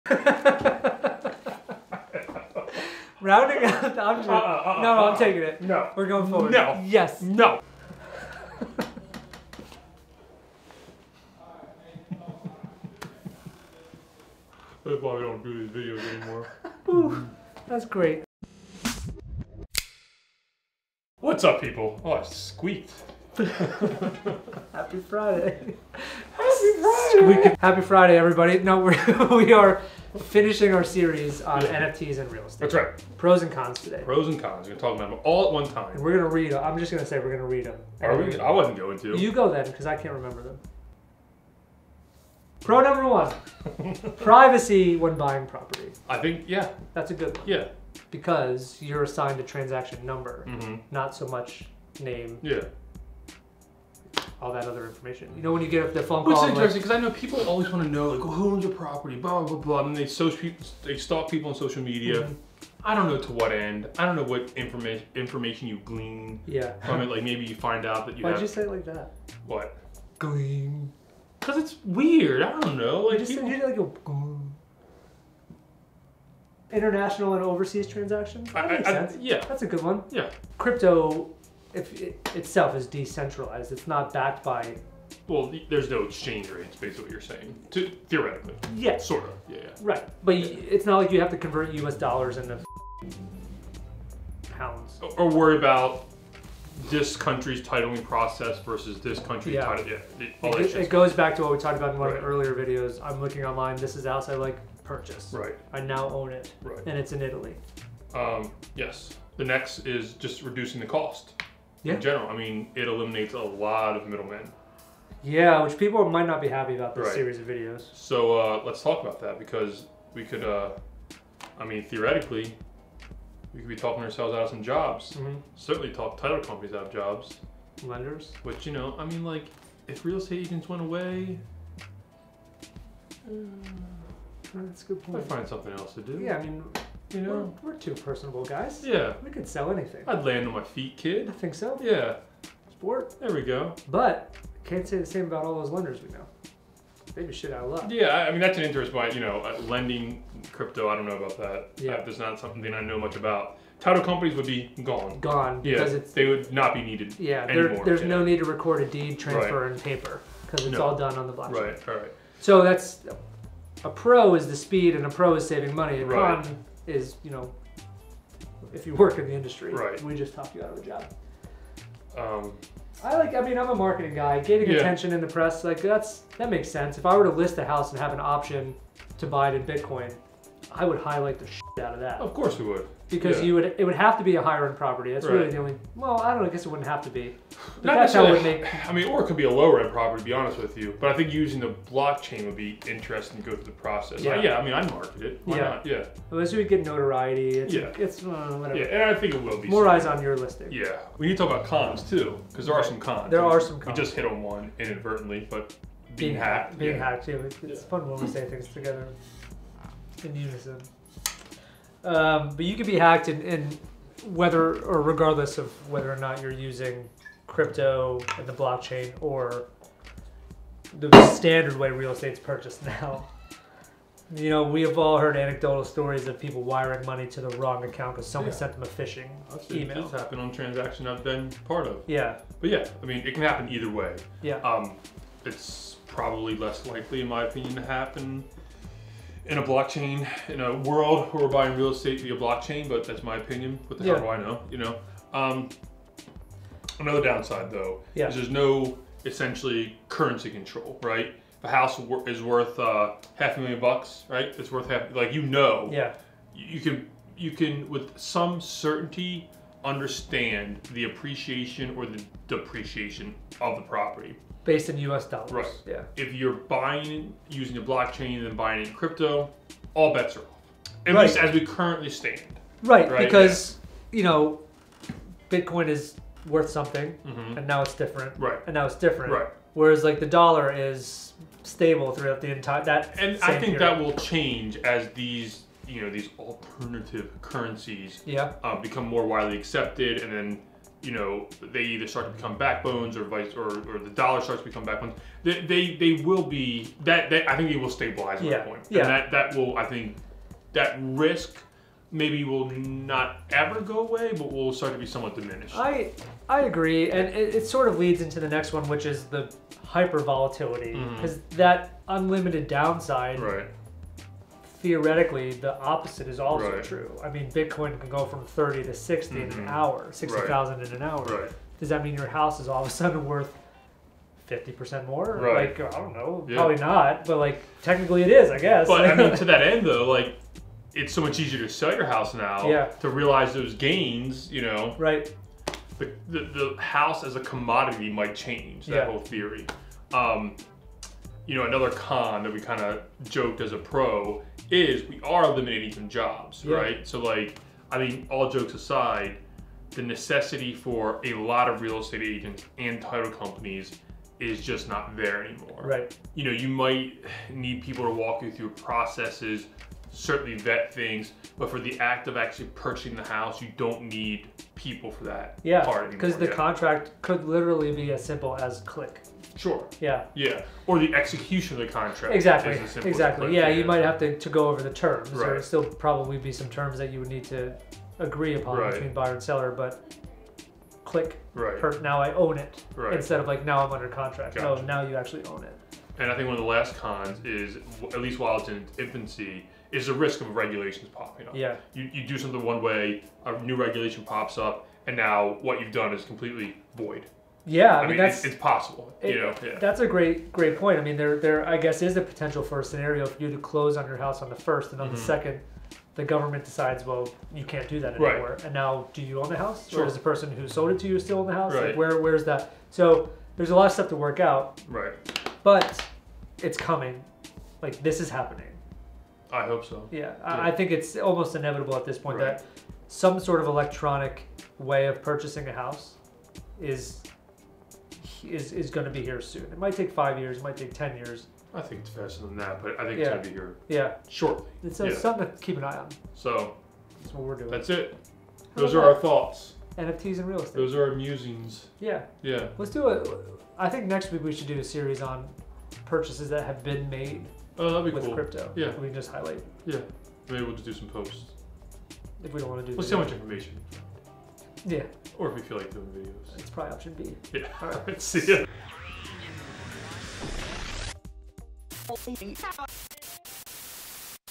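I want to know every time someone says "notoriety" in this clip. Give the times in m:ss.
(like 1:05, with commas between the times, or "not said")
3:16.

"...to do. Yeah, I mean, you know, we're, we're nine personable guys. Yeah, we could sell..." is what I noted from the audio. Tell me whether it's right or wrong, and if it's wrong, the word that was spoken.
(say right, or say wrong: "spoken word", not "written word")
wrong: "two", not "nine".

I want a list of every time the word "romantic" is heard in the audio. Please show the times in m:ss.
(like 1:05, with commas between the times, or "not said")
not said.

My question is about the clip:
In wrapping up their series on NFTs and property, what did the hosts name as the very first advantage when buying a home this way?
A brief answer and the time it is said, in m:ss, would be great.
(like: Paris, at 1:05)
Privacy, at 0:44.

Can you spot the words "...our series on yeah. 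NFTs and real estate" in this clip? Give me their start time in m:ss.
0:30.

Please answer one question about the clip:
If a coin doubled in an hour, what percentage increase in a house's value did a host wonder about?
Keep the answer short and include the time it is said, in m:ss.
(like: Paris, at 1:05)
50%, at 5:24.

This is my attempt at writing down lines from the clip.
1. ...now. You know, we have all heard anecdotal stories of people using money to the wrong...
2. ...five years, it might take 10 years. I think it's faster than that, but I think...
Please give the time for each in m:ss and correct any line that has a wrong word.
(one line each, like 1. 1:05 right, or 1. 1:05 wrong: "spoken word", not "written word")
1. 3:42 wrong: "wiring", not "using"
2. 7:10 right.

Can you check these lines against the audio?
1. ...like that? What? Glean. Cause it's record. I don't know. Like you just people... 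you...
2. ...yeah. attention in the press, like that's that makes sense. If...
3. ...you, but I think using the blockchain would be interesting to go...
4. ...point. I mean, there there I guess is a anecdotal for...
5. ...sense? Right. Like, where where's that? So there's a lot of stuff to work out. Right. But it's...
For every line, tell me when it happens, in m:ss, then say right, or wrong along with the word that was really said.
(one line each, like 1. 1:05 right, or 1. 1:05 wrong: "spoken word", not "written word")
1. 1:08 wrong: "weird", not "record"
2. 2:54 right
3. 3:10 right
4. 6:40 wrong: "potential", not "anecdotal"
5. 6:51 wrong: "house", not "sense".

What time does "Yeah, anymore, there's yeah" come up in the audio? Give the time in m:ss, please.
2:37.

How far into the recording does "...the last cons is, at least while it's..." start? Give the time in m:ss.
6:26.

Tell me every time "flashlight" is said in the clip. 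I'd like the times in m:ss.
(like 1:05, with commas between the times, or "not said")
not said.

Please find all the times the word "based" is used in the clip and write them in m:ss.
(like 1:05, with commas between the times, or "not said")
1:26, 4:24.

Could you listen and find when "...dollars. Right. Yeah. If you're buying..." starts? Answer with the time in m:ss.
4:25.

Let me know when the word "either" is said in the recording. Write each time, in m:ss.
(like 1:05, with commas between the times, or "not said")
3:53, 4:51.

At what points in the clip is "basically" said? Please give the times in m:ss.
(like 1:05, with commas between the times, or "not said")
1:26.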